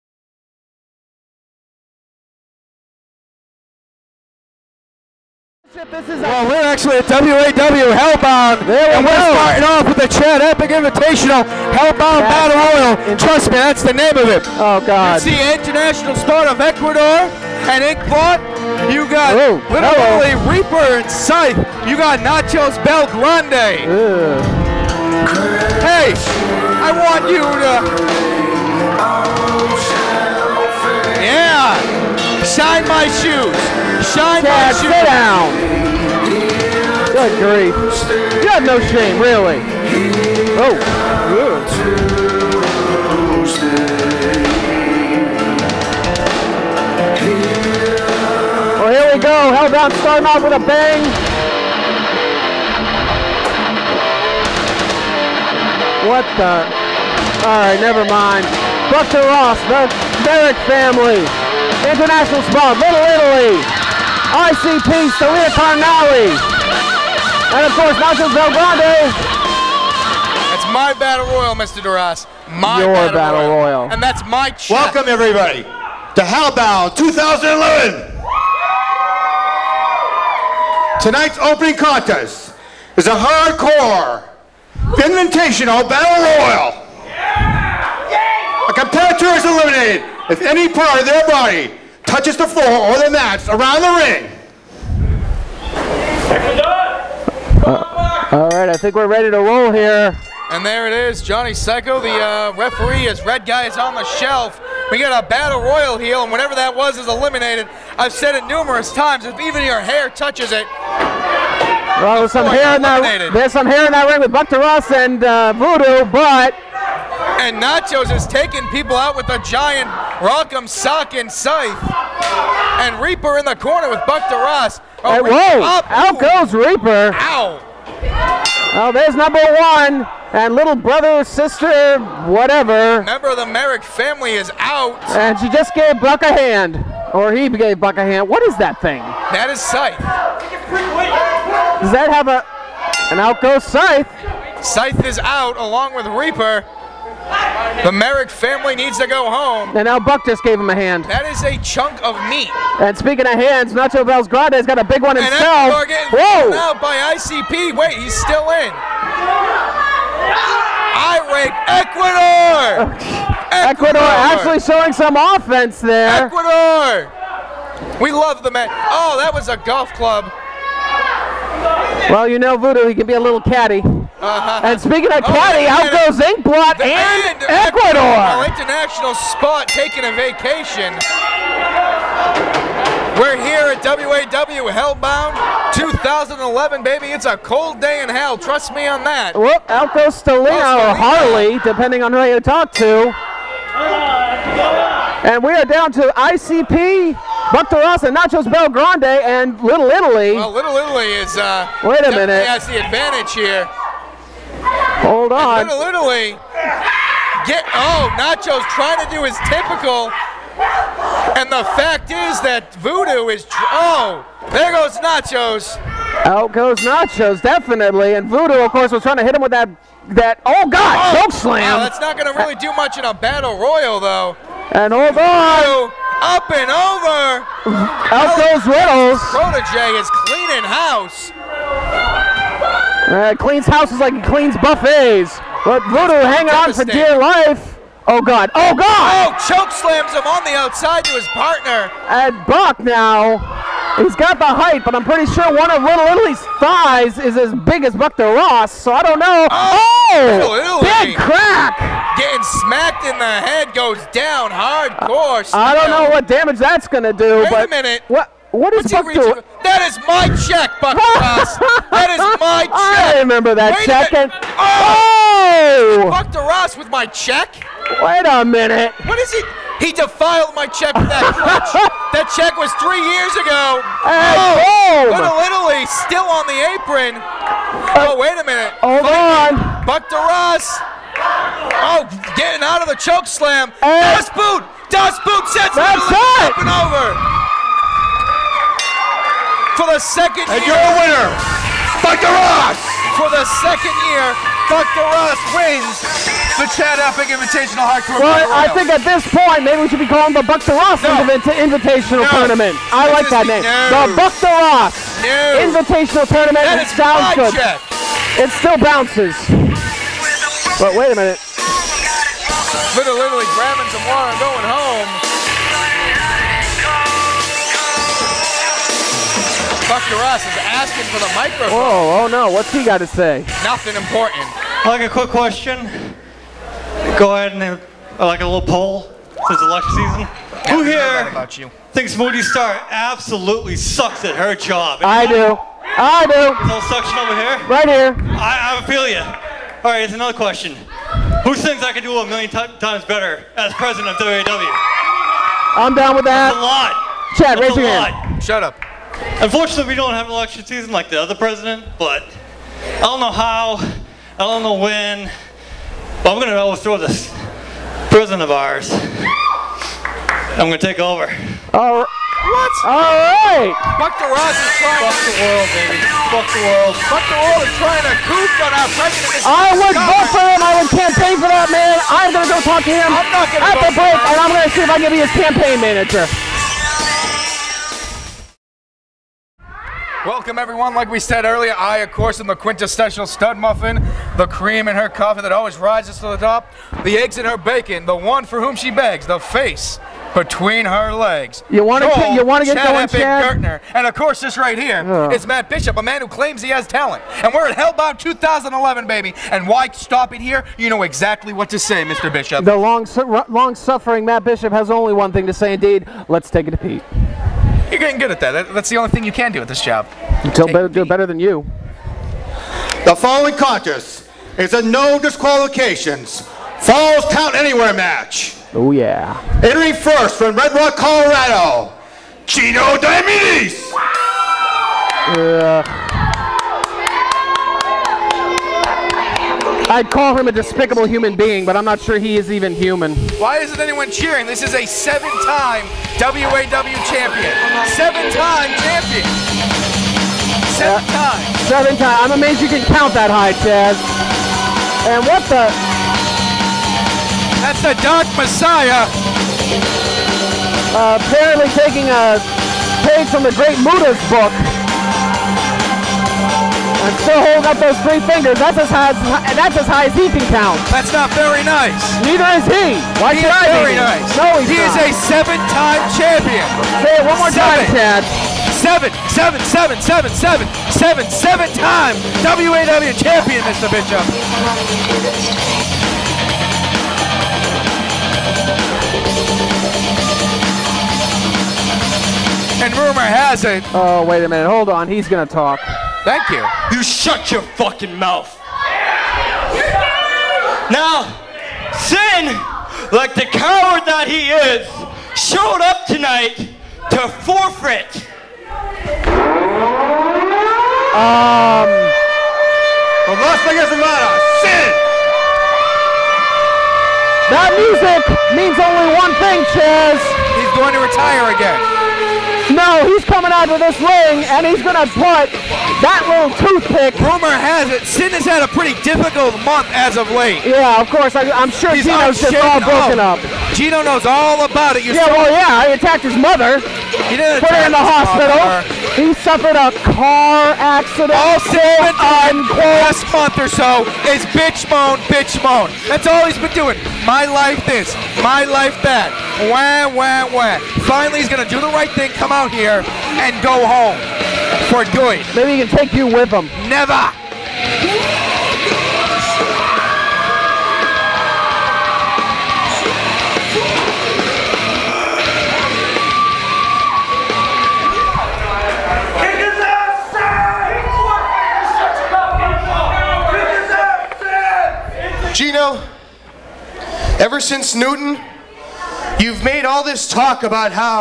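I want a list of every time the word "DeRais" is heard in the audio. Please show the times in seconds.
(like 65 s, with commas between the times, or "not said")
114 s, 124 s, 266 s, 280 s.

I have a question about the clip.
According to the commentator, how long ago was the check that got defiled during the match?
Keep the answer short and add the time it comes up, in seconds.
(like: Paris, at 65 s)
3 years ago, at 272 s.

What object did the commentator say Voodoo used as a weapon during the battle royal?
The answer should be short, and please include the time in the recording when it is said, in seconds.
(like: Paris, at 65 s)
A golf club, at 169 s.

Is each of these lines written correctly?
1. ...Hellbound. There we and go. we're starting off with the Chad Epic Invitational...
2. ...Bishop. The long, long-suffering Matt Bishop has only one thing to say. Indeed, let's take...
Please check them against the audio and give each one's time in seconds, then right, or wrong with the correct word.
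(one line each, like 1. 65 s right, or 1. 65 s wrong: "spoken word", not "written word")
1. 7 s right
2. 402 s right.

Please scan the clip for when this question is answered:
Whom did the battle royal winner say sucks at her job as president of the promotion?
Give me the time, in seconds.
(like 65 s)
332 s.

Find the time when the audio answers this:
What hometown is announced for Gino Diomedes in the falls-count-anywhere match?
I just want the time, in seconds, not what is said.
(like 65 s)
420 s.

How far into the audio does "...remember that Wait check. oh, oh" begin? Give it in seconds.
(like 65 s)
263 s.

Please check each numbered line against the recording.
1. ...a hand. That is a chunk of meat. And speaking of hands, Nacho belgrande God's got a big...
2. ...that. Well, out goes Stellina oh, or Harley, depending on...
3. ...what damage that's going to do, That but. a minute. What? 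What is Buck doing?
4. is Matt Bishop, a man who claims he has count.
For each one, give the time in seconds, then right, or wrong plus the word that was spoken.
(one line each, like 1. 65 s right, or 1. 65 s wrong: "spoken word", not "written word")
1. 150 s wrong: "Grande", not "God"
2. 189 s right
3. 256 s wrong: "Wait", not "That"
4. 395 s wrong: "talent", not "count".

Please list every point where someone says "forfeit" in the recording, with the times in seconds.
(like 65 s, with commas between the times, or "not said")
497 s.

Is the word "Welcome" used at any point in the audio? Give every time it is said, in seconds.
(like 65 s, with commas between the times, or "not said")
74 s, 380 s.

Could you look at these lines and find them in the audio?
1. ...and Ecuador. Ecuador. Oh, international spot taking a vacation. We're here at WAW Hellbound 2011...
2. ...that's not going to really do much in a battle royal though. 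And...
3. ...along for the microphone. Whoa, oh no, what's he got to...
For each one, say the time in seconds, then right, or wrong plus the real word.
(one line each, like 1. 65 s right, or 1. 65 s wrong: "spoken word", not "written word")
1. 176 s right
2. 221 s right
3. 320 s wrong: "asking", not "along".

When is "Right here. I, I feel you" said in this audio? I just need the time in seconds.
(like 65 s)
337 s.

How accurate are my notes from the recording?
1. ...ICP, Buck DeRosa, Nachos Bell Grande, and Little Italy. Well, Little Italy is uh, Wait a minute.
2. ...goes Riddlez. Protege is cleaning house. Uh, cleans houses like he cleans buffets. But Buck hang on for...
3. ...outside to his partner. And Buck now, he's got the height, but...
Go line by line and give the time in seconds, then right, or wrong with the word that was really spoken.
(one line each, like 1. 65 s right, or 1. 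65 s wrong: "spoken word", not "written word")
1. 196 s right
2. 228 s wrong: "Voodoo", not "Buck"
3. 240 s right.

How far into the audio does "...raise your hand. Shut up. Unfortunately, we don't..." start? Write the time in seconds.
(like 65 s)
347 s.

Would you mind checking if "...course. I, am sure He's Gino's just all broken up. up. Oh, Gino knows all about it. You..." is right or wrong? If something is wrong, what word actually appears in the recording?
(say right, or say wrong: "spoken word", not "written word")
right.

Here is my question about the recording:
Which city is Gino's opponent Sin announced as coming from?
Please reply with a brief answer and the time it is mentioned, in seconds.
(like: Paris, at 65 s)
Las Vegas, Nevada, at 503 s.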